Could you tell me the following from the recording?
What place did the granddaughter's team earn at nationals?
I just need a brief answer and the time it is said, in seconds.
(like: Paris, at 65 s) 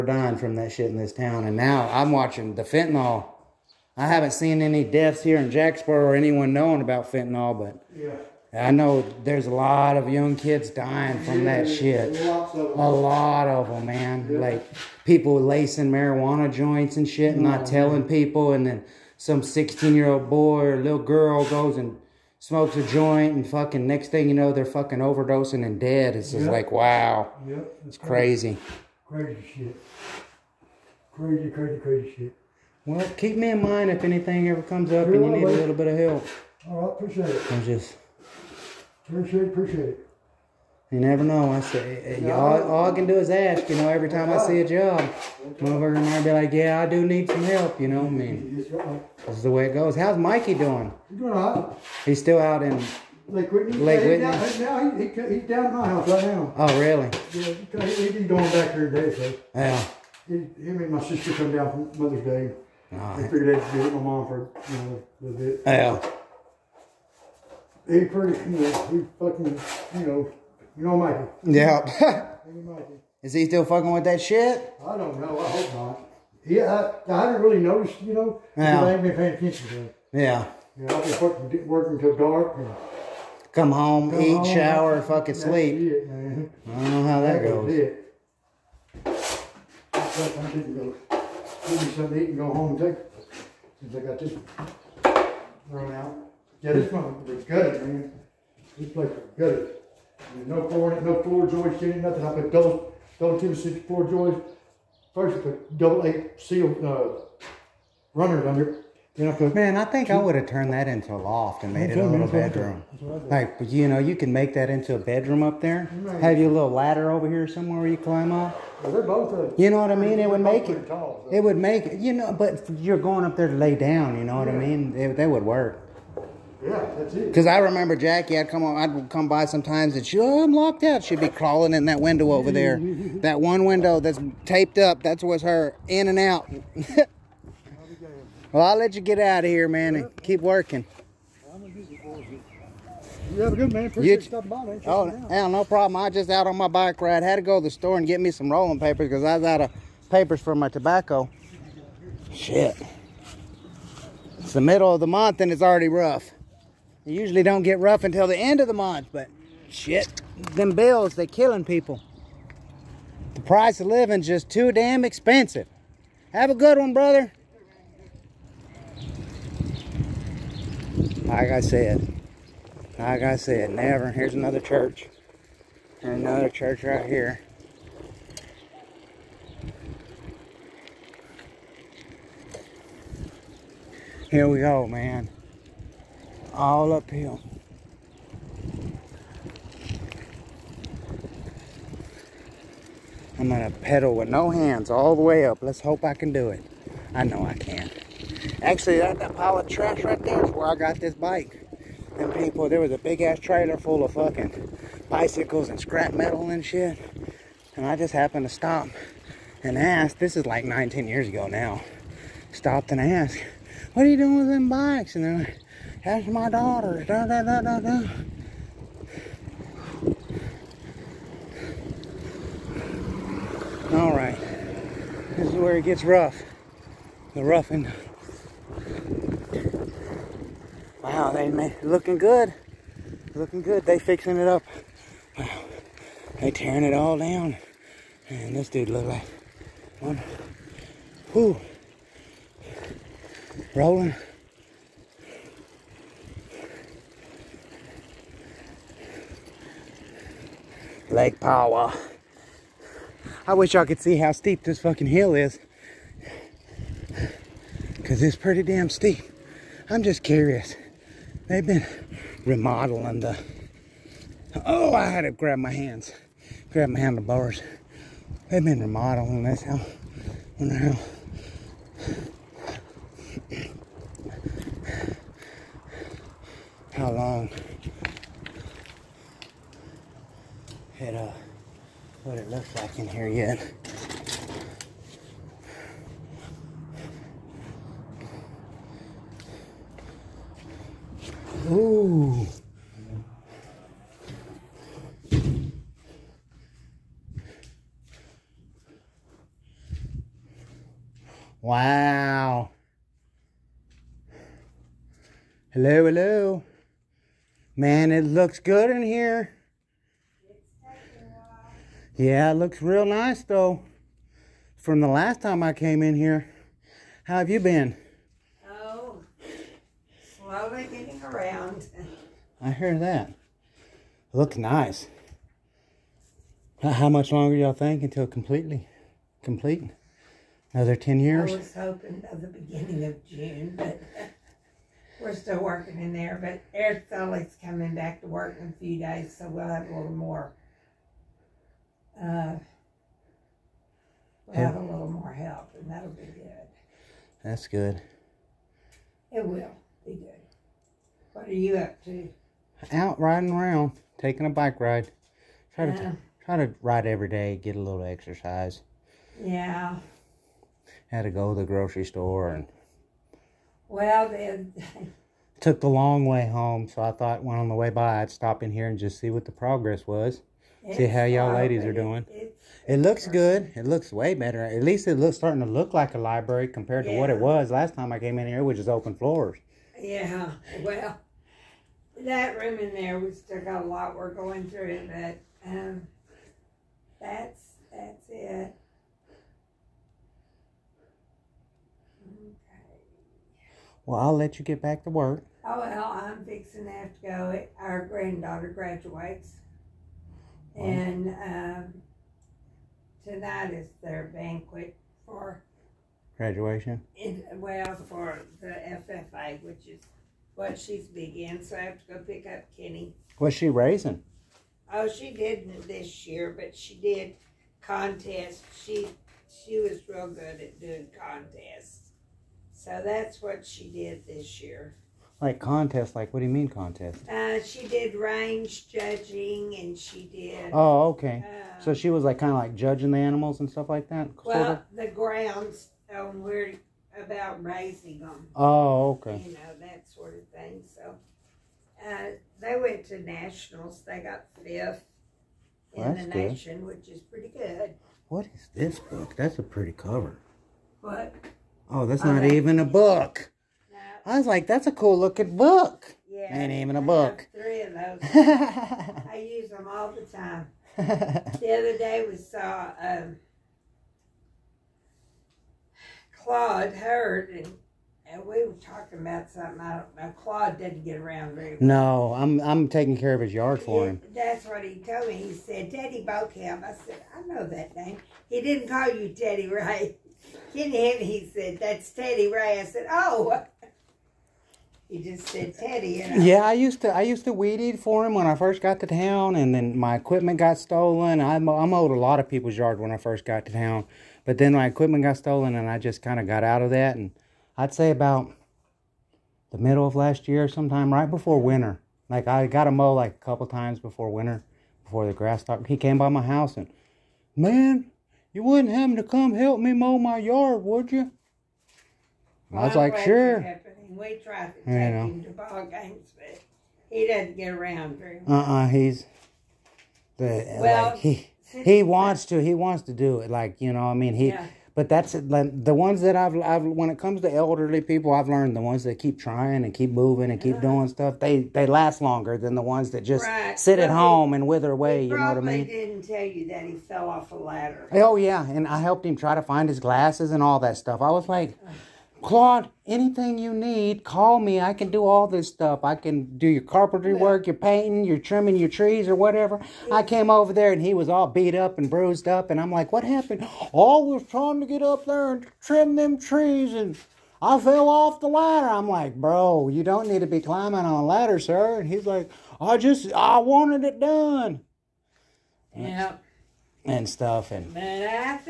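Fifth, at 444 s.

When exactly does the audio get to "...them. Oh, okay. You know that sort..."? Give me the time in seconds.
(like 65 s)
438 s.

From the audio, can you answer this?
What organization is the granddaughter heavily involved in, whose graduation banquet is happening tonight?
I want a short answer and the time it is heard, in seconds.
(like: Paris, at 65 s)
FFA, at 408 s.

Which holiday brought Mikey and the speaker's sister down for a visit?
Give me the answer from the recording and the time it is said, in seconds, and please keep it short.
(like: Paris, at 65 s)
Mother's Day, at 62 s.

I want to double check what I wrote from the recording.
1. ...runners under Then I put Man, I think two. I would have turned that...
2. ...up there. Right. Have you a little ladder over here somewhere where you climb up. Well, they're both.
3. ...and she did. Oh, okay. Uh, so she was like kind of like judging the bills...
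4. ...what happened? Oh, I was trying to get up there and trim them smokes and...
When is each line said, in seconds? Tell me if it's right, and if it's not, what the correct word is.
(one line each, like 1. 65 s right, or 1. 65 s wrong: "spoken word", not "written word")
1. 108 s right
2. 115 s right
3. 429 s wrong: "animals", not "bills"
4. 553 s wrong: "trees", not "smokes".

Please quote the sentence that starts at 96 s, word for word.
Yeah, this one was good, man.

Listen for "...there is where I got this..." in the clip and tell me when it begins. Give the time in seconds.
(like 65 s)
200 s.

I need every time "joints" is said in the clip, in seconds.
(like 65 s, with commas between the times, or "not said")
16 s, 22 s.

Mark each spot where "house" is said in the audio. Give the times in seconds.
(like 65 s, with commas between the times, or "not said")
55 s, 506 s.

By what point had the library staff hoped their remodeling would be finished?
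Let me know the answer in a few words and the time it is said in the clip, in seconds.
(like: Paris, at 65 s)
Beginning of June, at 332 s.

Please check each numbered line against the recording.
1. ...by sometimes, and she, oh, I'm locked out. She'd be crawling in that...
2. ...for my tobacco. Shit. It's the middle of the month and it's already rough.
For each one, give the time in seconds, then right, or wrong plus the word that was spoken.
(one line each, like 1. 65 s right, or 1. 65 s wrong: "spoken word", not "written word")
1. 129 s right
2. 150 s right.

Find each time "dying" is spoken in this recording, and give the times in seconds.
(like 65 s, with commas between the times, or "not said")
0 s, 10 s.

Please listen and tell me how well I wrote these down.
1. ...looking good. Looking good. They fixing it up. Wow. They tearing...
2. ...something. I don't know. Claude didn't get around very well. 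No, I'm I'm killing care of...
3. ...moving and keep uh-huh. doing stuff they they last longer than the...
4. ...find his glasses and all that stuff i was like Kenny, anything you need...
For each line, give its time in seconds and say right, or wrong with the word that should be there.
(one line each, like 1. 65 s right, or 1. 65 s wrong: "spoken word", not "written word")
1. 231 s right
2. 469 s wrong: "taking", not "killing"
3. 530 s right
4. 539 s wrong: "Claude", not "Kenny".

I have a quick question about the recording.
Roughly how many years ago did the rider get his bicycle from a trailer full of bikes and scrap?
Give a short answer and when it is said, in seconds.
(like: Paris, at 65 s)
9 or 10 years, at 210 s.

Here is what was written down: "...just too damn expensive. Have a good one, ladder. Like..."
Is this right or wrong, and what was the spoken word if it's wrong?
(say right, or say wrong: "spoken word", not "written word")
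wrong: "brother", not "ladder".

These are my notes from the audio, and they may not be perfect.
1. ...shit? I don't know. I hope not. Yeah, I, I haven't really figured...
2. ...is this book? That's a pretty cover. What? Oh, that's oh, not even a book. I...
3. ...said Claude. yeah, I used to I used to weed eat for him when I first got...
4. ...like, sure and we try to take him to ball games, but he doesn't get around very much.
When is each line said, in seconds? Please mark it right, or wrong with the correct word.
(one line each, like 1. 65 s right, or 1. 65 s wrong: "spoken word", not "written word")
1. 74 s wrong: "noticed", not "figured"
2. 448 s right
3. 485 s wrong: "Teddy", not "Claude"
4. 513 s right.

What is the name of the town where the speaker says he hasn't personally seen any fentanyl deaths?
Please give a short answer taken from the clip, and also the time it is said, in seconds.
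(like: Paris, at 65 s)
Jacksboro, at 5 s.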